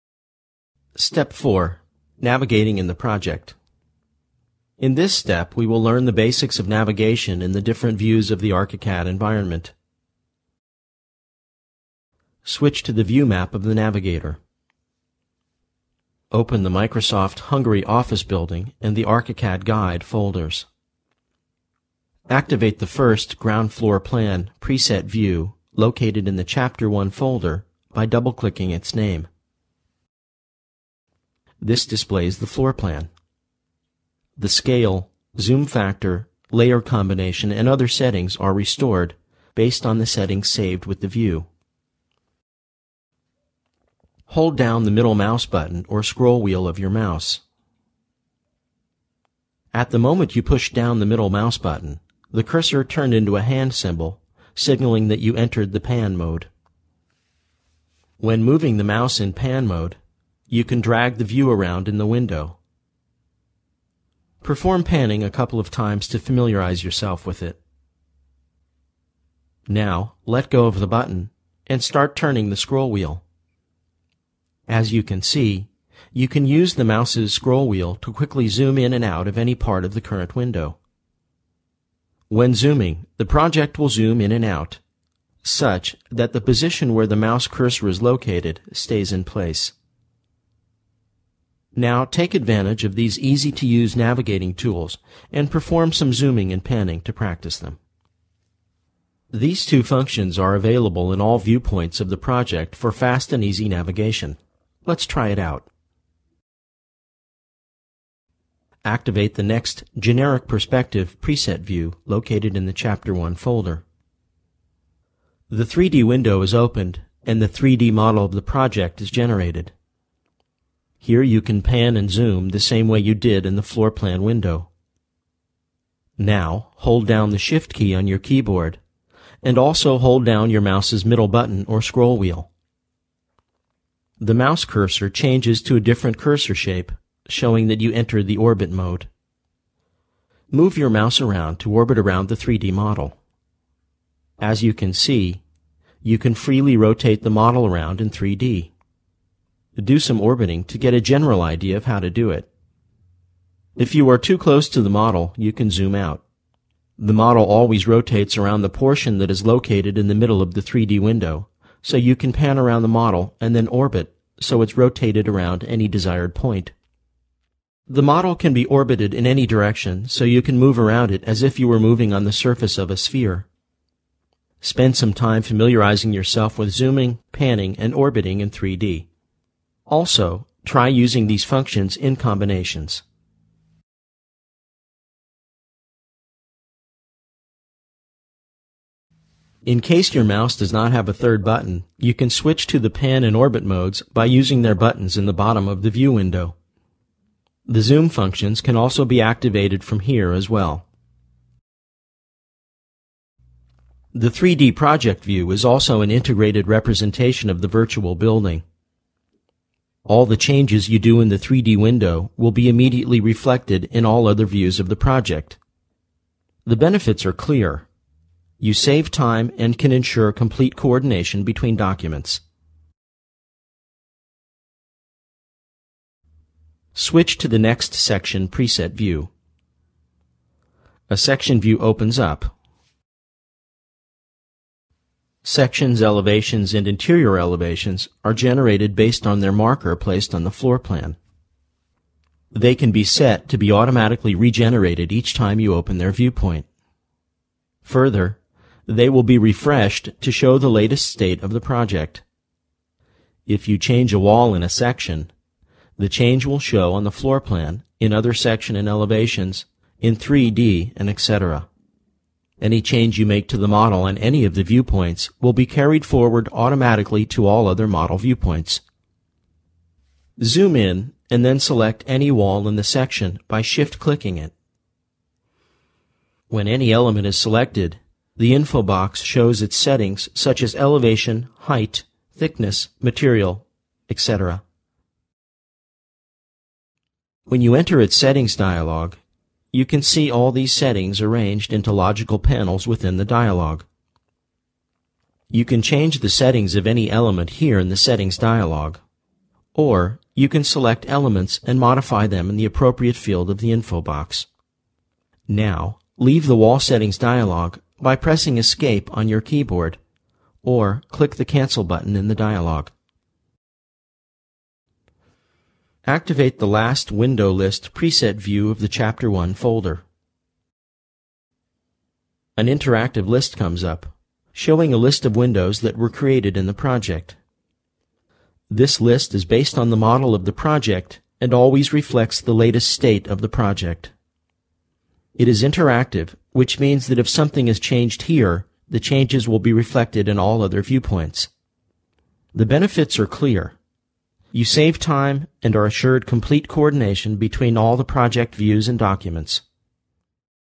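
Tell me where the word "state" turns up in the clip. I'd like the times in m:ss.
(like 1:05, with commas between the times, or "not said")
4:11, 5:32.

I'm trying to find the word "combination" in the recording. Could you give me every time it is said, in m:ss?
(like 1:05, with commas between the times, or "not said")
0:36, 3:02.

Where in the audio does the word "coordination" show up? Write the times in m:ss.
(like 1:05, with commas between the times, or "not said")
3:40, 5:46.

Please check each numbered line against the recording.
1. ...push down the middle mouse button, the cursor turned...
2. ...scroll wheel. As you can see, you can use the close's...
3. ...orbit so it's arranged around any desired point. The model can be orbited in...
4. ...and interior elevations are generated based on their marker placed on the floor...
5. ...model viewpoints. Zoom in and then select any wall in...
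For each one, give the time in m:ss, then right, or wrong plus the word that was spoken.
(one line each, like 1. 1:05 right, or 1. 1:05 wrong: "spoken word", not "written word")
1. 0:50 right
2. 1:12 wrong: "mouse", not "close"
3. 2:43 wrong: "rotated", not "arranged"
4. 3:56 right
5. 4:27 right.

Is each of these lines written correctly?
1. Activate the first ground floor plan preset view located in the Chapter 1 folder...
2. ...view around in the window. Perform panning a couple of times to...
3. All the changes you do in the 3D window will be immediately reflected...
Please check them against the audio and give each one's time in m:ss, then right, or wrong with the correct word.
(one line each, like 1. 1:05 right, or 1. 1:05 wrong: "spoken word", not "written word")
1. 0:22 right
2. 1:01 right
3. 3:30 right.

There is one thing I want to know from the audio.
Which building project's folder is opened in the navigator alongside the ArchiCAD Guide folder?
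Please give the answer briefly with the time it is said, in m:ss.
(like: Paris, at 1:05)
Microsoft Hungary Office Building, at 0:16.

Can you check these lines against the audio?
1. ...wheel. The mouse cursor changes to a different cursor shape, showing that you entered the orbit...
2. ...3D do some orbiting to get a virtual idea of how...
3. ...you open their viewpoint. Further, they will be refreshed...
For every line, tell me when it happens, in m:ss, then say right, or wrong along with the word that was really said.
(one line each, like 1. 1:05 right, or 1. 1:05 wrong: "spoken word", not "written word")
1. 2:12 right
2. 2:28 wrong: "general", not "virtual"
3. 4:05 right.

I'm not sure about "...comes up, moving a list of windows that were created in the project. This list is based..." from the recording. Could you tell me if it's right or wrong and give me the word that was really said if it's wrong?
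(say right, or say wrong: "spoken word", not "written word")
wrong: "showing", not "moving".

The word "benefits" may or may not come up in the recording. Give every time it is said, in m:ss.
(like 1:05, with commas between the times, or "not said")
3:36, 5:42.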